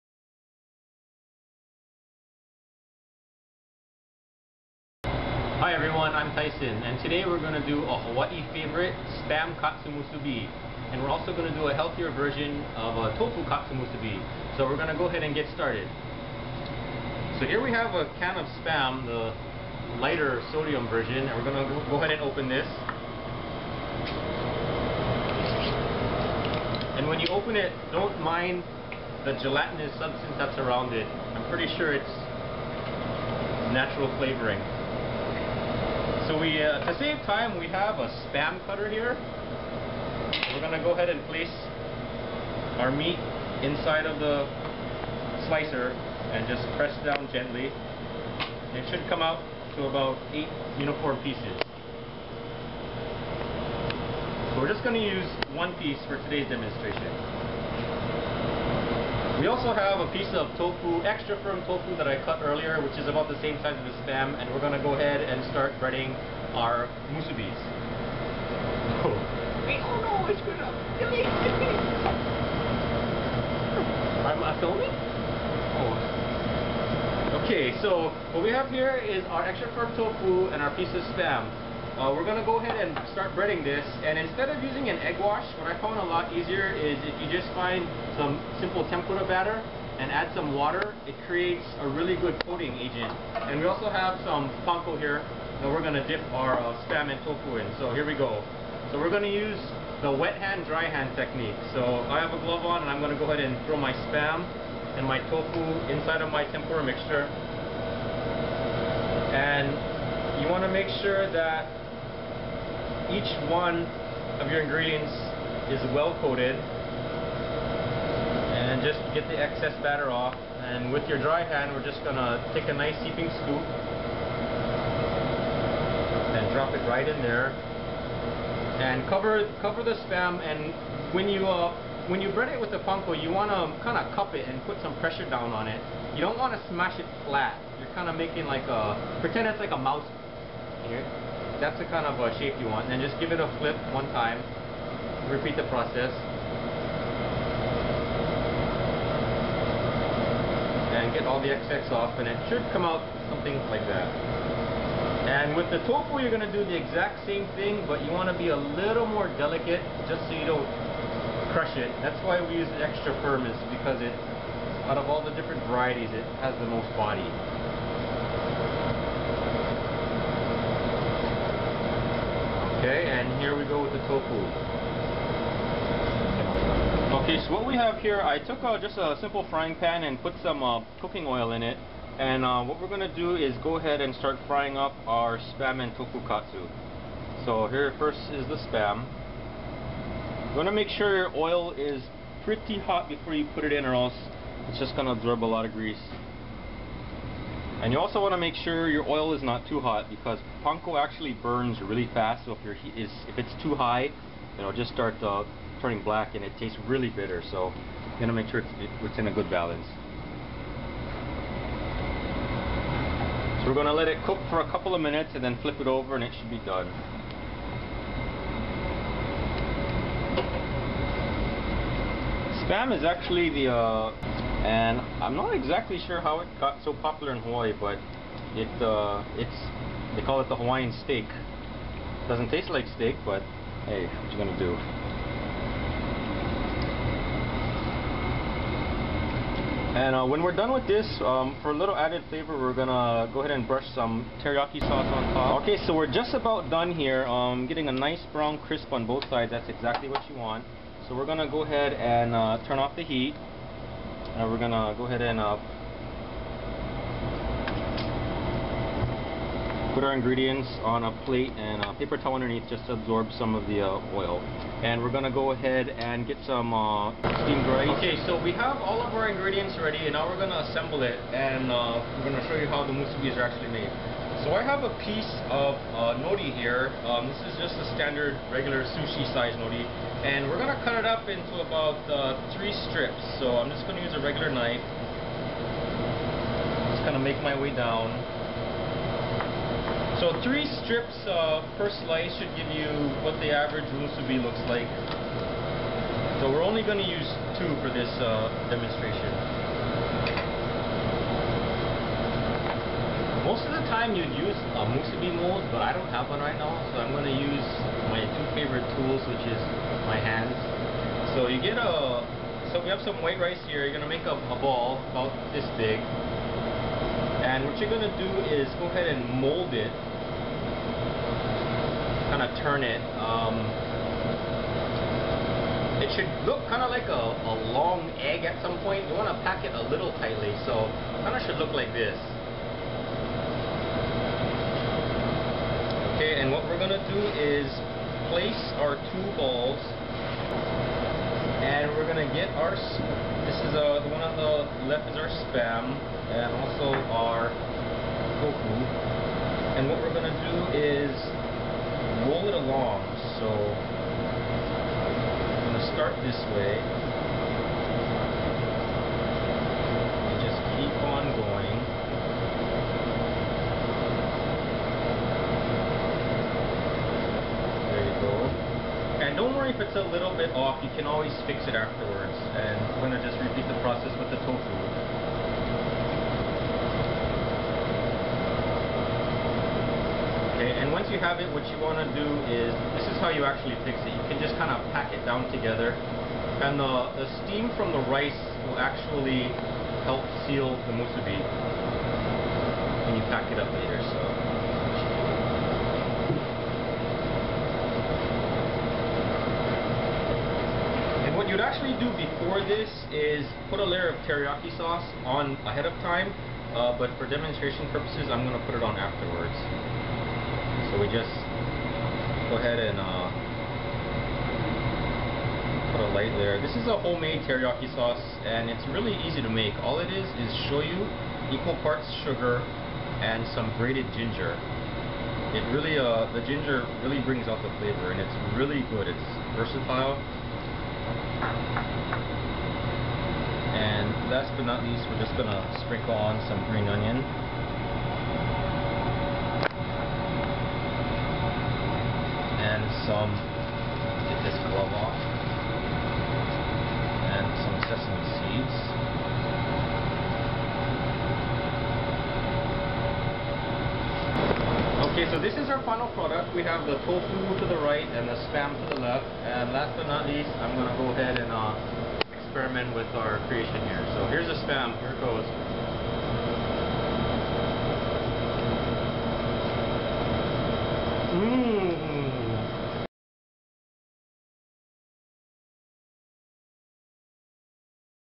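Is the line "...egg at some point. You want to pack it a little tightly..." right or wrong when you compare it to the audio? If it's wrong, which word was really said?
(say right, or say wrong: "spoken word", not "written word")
right.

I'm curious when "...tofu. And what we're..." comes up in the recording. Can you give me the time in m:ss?
5:48.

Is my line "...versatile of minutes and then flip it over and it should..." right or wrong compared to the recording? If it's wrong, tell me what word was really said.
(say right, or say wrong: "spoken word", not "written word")
wrong: "couple", not "versatile".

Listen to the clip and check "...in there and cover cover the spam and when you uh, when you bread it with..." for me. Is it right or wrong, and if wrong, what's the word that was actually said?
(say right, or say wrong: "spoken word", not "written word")
right.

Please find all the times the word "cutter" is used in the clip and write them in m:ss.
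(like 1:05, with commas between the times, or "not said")
0:38.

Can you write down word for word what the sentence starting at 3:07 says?
So here first is the spam.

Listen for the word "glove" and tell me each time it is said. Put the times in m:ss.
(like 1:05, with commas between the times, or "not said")
1:42, 7:24.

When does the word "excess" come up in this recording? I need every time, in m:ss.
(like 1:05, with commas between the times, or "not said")
1:59, 2:31.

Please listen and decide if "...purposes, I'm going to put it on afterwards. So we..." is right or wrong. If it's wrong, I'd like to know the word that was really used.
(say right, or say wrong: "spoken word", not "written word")
right.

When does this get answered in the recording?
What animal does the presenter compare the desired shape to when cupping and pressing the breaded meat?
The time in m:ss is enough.
2:19.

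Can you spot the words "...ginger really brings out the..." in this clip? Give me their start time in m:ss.
7:06.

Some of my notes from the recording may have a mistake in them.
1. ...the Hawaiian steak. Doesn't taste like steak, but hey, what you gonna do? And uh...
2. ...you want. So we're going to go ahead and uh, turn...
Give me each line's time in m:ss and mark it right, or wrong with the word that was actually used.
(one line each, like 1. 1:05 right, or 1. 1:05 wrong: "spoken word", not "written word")
1. 3:50 right
2. 4:10 right.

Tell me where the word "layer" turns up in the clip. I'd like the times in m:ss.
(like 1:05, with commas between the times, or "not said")
6:43, 6:56.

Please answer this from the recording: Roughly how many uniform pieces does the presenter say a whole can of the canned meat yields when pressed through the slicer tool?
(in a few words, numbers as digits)
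8.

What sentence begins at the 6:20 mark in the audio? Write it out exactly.
Okay, and once you have it, what you want to do is, this is how you actually fix it.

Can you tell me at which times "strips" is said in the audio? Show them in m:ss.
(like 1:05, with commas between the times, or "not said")
4:42, 4:50.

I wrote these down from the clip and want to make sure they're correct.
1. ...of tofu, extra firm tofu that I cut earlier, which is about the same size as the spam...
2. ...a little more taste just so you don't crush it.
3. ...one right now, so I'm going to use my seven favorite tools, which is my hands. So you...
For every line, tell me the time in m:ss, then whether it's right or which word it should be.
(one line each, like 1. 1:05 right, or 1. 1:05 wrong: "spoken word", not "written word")
1. 1:00 right
2. 2:38 wrong: "delicate", not "taste"
3. 5:06 wrong: "two", not "seven".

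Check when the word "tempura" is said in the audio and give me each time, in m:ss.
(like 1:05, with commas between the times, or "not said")
1:28, 1:46.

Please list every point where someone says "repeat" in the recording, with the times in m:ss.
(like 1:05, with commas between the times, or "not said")
2:25, 6:13.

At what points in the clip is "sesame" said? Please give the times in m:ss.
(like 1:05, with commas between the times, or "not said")
7:27.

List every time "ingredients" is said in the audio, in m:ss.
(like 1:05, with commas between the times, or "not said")
1:54, 4:20, 4:29.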